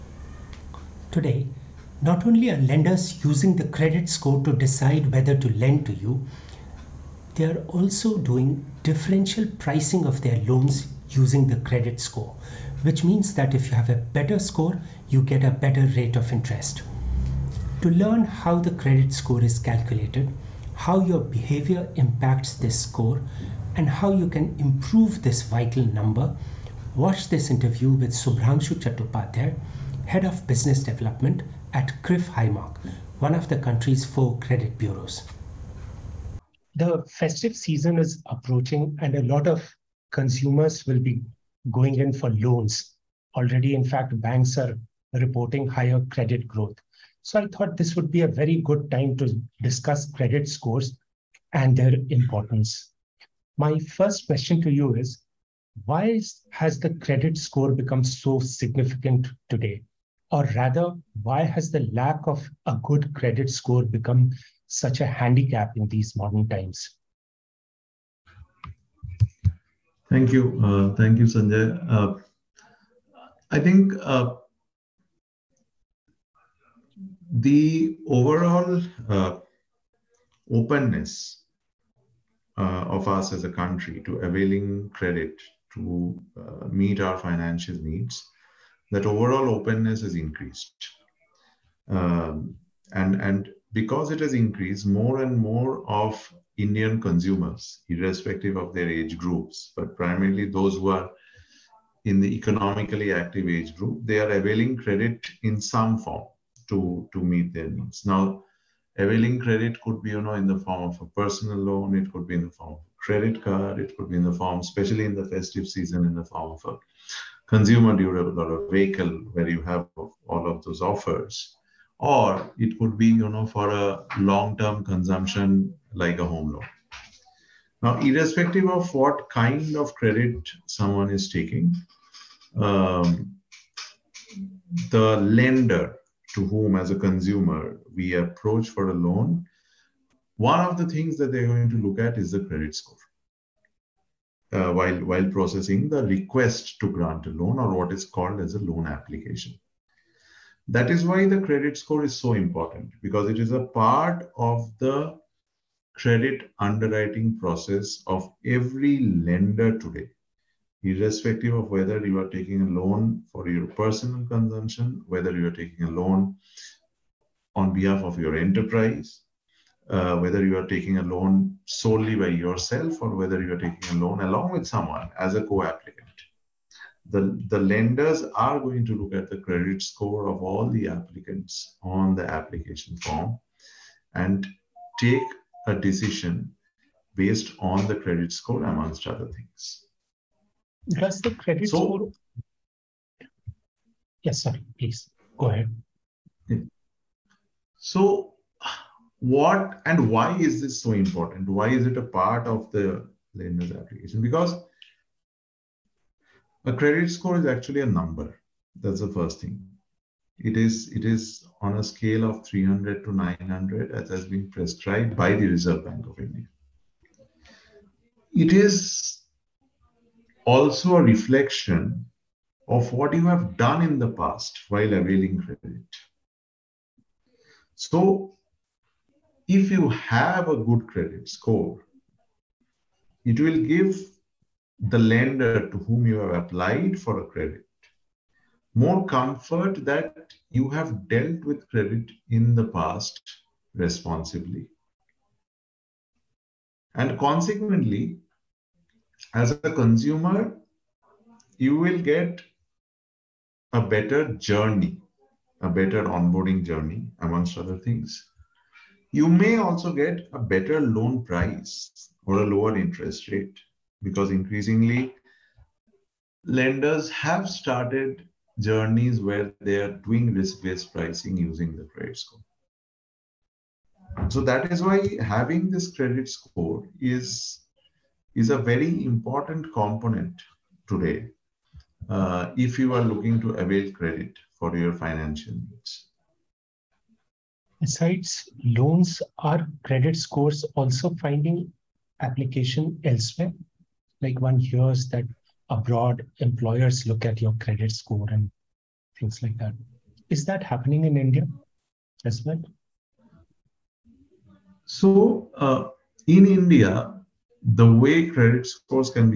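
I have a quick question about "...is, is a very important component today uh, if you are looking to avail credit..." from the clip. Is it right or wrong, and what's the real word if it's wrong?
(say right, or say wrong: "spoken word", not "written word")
right.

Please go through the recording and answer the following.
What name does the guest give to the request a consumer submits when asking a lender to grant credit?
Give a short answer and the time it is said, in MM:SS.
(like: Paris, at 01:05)
loan application, at 02:28.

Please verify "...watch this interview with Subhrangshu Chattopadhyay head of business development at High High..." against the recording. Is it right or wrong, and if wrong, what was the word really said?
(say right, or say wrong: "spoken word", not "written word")
wrong: "CRIF", not "High".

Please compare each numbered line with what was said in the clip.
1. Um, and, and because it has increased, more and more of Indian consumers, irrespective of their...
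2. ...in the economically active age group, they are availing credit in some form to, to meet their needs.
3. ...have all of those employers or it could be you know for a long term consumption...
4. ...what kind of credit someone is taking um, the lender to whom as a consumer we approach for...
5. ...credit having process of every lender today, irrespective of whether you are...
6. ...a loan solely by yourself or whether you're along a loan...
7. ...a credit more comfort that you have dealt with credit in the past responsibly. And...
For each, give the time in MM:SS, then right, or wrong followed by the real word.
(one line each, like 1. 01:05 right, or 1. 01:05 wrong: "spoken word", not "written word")
1. 01:31 right
2. 01:42 right
3. 01:59 wrong: "offers", not "employers"
4. 02:08 right
5. 02:35 wrong: "underwriting", not "having"
6. 02:50 wrong: "taking", not "along"
7. 03:57 right.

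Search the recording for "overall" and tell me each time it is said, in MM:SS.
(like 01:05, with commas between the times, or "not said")
01:18, 01:29.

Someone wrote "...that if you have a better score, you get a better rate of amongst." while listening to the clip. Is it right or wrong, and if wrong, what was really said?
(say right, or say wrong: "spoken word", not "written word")
wrong: "interest", not "amongst".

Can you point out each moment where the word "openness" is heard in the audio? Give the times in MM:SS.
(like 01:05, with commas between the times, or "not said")
01:20, 01:29.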